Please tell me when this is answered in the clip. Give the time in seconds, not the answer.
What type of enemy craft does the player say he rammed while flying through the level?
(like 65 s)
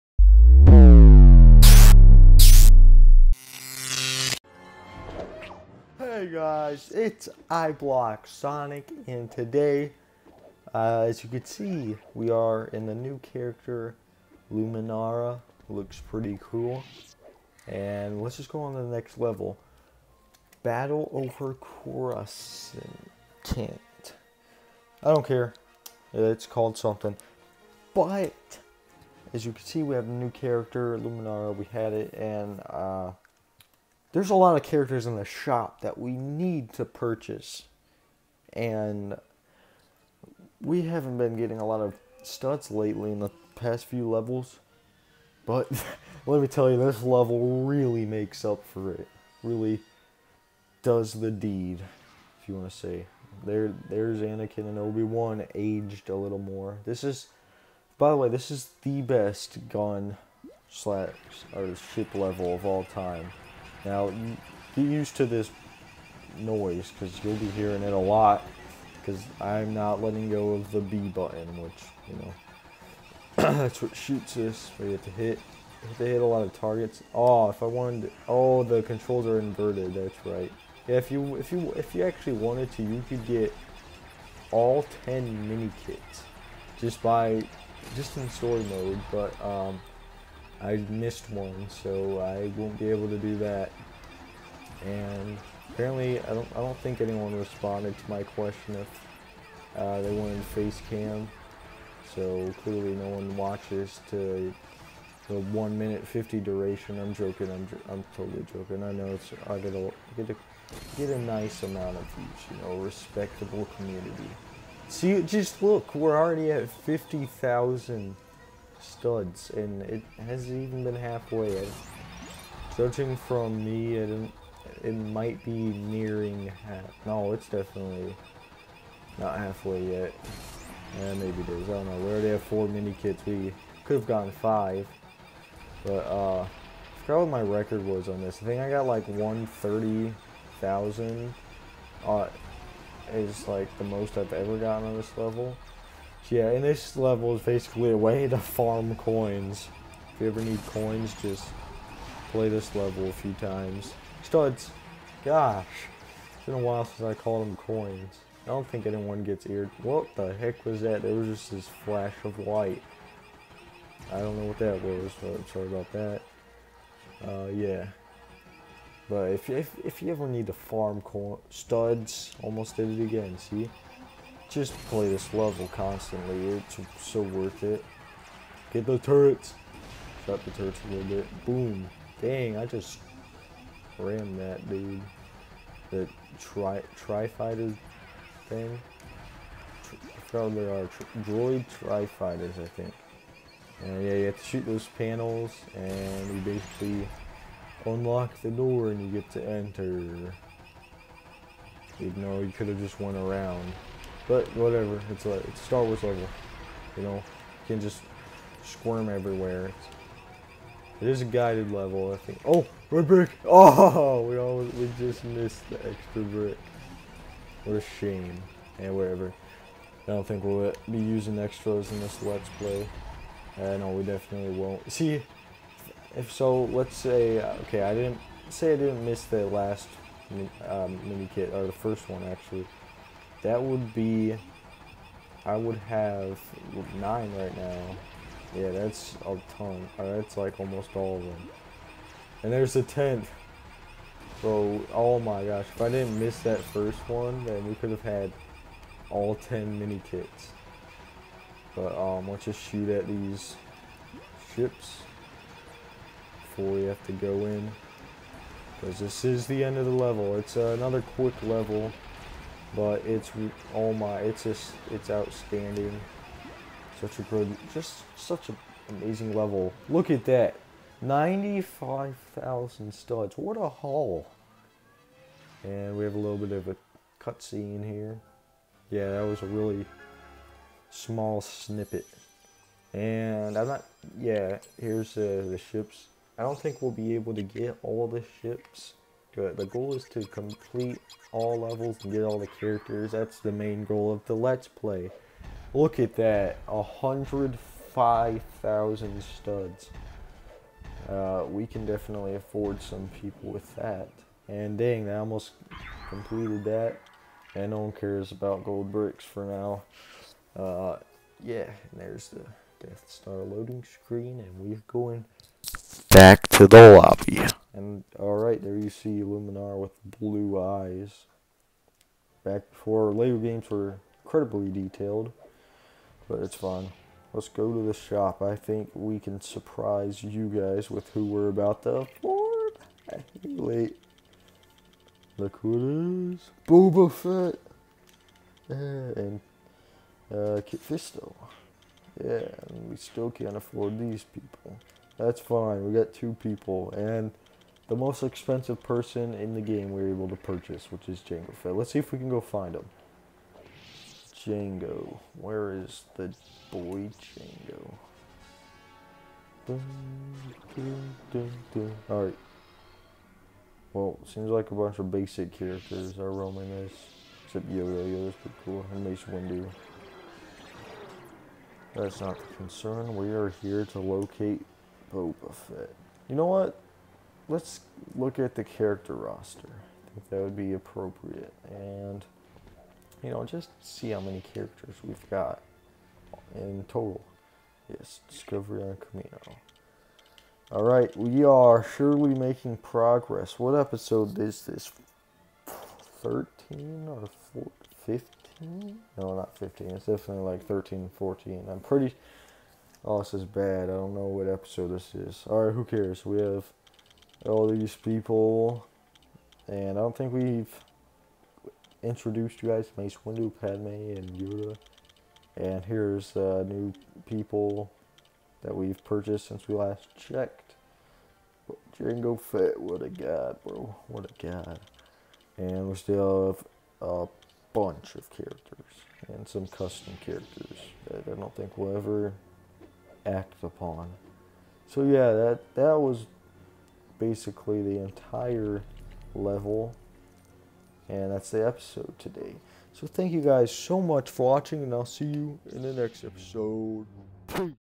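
191 s.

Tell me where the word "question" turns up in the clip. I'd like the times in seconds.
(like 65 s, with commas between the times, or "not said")
98 s.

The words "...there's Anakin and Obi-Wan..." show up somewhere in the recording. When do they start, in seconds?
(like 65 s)
53 s.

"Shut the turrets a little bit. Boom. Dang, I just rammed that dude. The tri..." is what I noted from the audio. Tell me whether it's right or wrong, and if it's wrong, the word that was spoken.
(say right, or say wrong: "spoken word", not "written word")
right.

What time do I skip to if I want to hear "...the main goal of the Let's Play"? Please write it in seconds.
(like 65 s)
293 s.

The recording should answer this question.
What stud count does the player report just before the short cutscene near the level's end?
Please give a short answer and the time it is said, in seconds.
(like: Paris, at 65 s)
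95,000, at 271 s.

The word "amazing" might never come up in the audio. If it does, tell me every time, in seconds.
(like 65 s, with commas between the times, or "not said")
268 s.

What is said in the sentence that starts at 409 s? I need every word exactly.
And I don't think we've introduced you guys to Mace Windu, Padme, and Yoda.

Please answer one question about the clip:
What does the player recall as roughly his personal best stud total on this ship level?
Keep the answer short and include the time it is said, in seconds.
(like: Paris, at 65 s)
130,000, at 139 s.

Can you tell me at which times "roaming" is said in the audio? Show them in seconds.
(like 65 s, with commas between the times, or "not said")
366 s.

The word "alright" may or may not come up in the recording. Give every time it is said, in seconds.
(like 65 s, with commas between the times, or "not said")
318 s, 362 s, 390 s, 405 s.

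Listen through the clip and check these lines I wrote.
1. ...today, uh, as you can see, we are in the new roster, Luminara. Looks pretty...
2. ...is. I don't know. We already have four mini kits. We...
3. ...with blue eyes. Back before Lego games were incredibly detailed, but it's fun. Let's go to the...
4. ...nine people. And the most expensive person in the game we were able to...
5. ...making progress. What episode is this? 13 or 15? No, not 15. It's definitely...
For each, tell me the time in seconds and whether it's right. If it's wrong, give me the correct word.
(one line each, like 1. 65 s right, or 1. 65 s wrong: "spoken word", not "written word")
1. 9 s wrong: "character", not "roster"
2. 131 s right
3. 319 s right
4. 346 s wrong: "two", not "nine"
5. 392 s right.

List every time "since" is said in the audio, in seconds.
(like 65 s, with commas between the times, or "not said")
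156 s, 419 s.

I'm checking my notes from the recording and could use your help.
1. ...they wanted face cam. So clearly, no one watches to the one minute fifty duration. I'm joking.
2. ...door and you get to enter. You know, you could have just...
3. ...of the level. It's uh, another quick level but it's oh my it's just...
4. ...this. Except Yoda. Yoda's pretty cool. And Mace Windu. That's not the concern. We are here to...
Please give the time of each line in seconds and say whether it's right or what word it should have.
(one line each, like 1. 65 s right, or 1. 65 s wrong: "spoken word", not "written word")
1. 100 s right
2. 198 s right
3. 259 s right
4. 366 s right.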